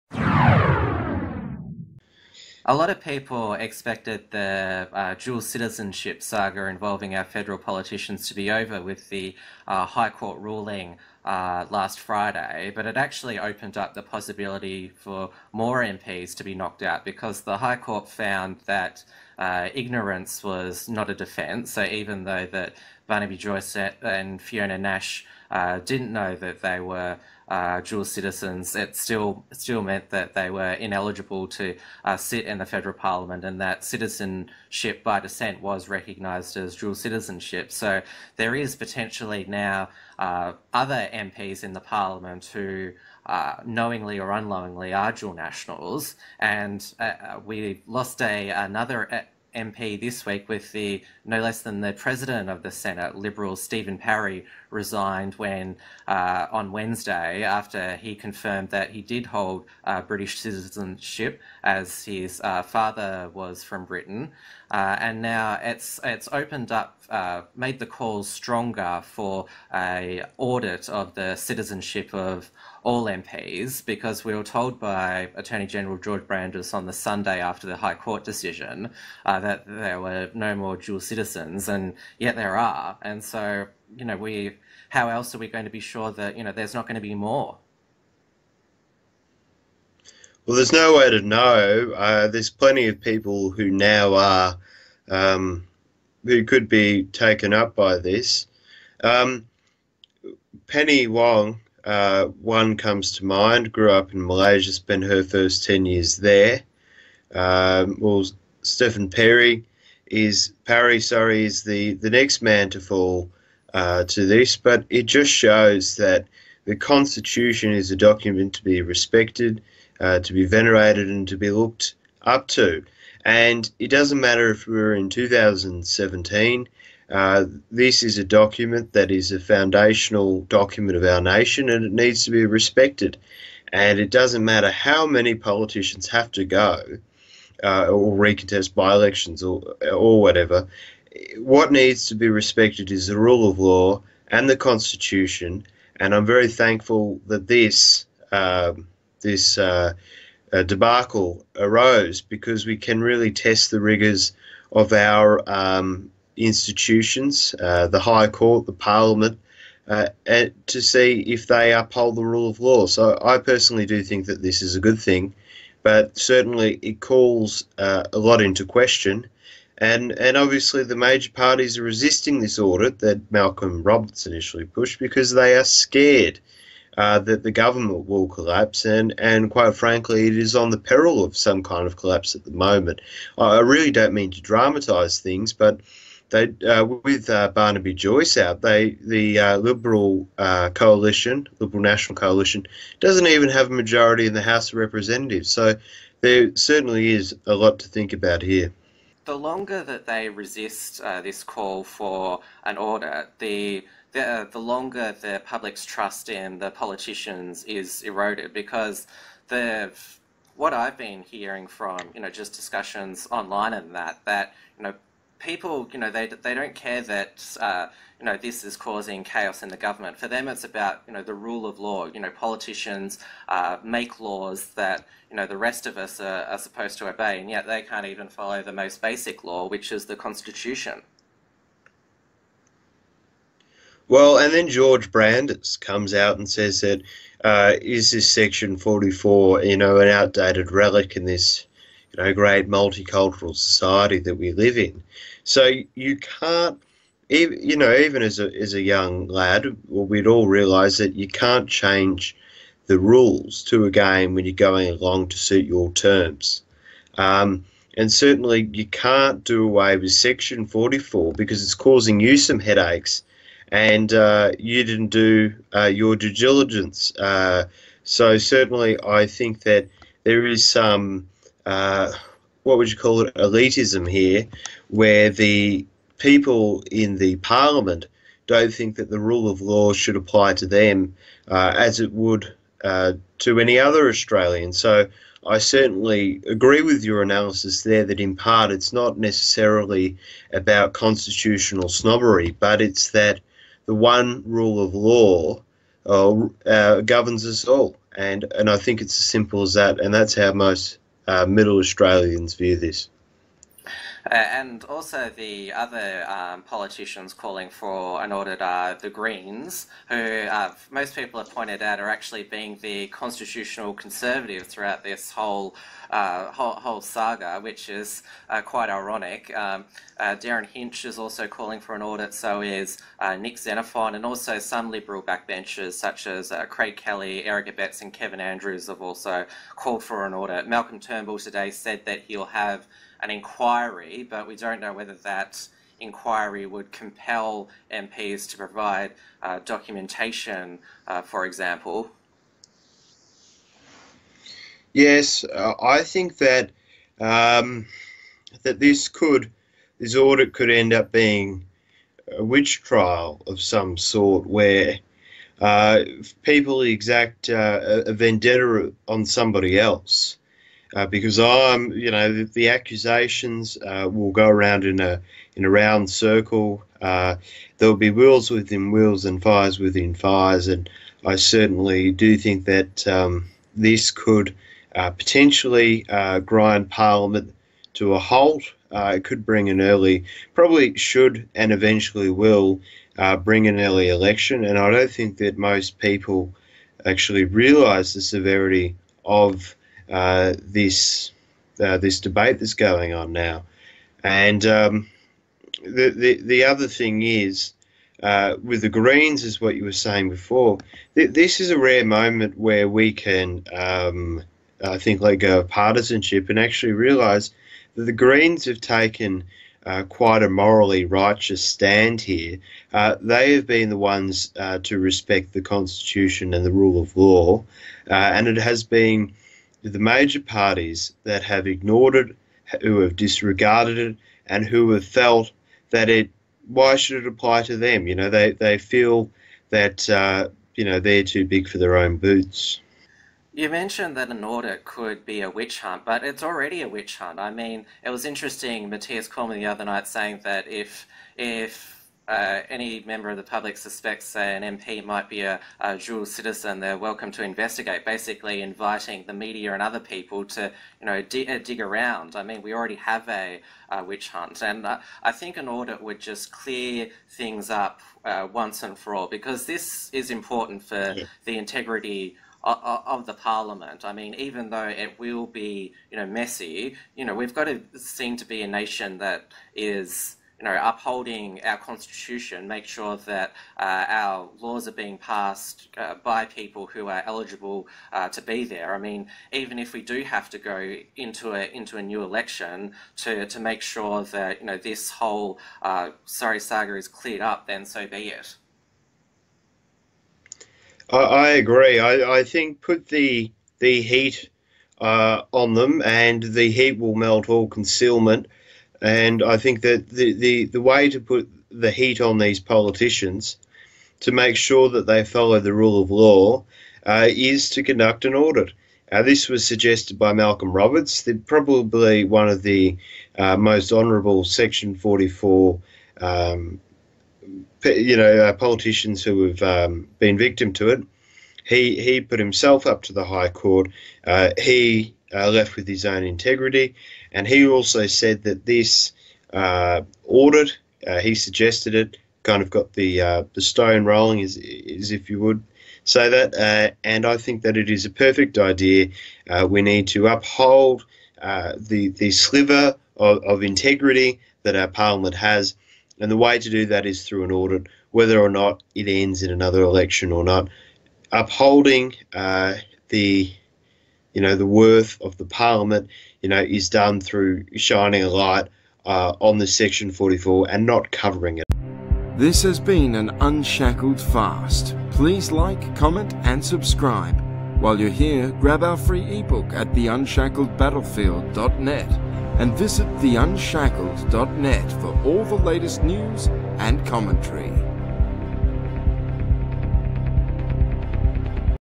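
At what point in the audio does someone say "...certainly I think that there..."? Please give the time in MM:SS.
04:28.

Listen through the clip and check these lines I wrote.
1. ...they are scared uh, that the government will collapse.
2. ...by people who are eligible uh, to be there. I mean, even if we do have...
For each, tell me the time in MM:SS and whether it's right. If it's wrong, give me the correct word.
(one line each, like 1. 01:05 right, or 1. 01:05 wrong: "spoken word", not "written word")
1. 02:55 right
2. 07:56 right.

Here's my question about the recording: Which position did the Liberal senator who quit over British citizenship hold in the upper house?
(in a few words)
President of the Senate.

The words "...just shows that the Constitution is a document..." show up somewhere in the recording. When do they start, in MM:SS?
01:55.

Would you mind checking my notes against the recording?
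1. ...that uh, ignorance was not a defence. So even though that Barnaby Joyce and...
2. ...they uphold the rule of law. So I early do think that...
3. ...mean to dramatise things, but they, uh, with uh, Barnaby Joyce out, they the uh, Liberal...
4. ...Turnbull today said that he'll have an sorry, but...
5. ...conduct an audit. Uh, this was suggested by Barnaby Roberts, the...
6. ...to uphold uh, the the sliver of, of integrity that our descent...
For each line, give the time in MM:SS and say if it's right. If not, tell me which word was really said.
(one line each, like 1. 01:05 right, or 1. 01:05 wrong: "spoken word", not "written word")
1. 00:18 right
2. 02:41 wrong: "personally", not "early"
3. 03:04 right
4. 05:30 wrong: "inquiry", not "sorry"
5. 08:27 wrong: "Malcolm", not "Barnaby"
6. 09:00 wrong: "parliament", not "descent".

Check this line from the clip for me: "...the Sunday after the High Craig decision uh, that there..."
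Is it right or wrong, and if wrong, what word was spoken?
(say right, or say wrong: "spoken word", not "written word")
wrong: "Court", not "Craig".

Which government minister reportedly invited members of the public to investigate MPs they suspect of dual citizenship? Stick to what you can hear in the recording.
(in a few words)
Mathias Cormann.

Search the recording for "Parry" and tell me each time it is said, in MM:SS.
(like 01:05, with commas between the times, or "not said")
00:53, 01:50.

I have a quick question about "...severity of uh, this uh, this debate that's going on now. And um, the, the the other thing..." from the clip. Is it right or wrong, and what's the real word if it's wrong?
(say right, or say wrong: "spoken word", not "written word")
right.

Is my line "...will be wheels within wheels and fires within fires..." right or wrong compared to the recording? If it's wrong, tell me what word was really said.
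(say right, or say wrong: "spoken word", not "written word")
right.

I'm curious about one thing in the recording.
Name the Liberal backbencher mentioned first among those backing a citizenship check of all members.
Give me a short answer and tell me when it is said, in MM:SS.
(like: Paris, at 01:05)
Craig Kelly, at 05:26.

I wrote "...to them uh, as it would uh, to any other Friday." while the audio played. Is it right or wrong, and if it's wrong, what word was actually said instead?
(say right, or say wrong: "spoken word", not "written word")
wrong: "Australian", not "Friday".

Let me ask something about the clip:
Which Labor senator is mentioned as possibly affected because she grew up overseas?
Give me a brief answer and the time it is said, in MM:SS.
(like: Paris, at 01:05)
Penny Wong, at 01:40.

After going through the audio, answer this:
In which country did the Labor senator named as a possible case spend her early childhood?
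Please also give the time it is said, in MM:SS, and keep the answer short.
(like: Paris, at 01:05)
Malaysia, at 01:44.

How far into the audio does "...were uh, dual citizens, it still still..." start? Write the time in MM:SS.
00:26.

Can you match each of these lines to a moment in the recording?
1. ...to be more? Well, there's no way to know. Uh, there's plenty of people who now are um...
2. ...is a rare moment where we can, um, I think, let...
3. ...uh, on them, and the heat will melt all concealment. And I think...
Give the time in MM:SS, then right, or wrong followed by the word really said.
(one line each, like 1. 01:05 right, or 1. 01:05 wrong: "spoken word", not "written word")
1. 01:26 right
2. 06:41 right
3. 08:14 right.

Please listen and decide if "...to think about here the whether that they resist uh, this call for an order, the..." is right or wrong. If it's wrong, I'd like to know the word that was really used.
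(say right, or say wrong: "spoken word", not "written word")
wrong: "longer", not "whether".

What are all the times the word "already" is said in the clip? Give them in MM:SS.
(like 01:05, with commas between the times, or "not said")
07:16, 07:32.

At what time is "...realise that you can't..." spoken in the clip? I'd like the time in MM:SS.
04:10.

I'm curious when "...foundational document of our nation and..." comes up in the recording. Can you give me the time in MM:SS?
02:09.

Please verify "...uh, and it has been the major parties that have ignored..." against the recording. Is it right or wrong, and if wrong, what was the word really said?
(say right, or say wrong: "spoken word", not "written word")
right.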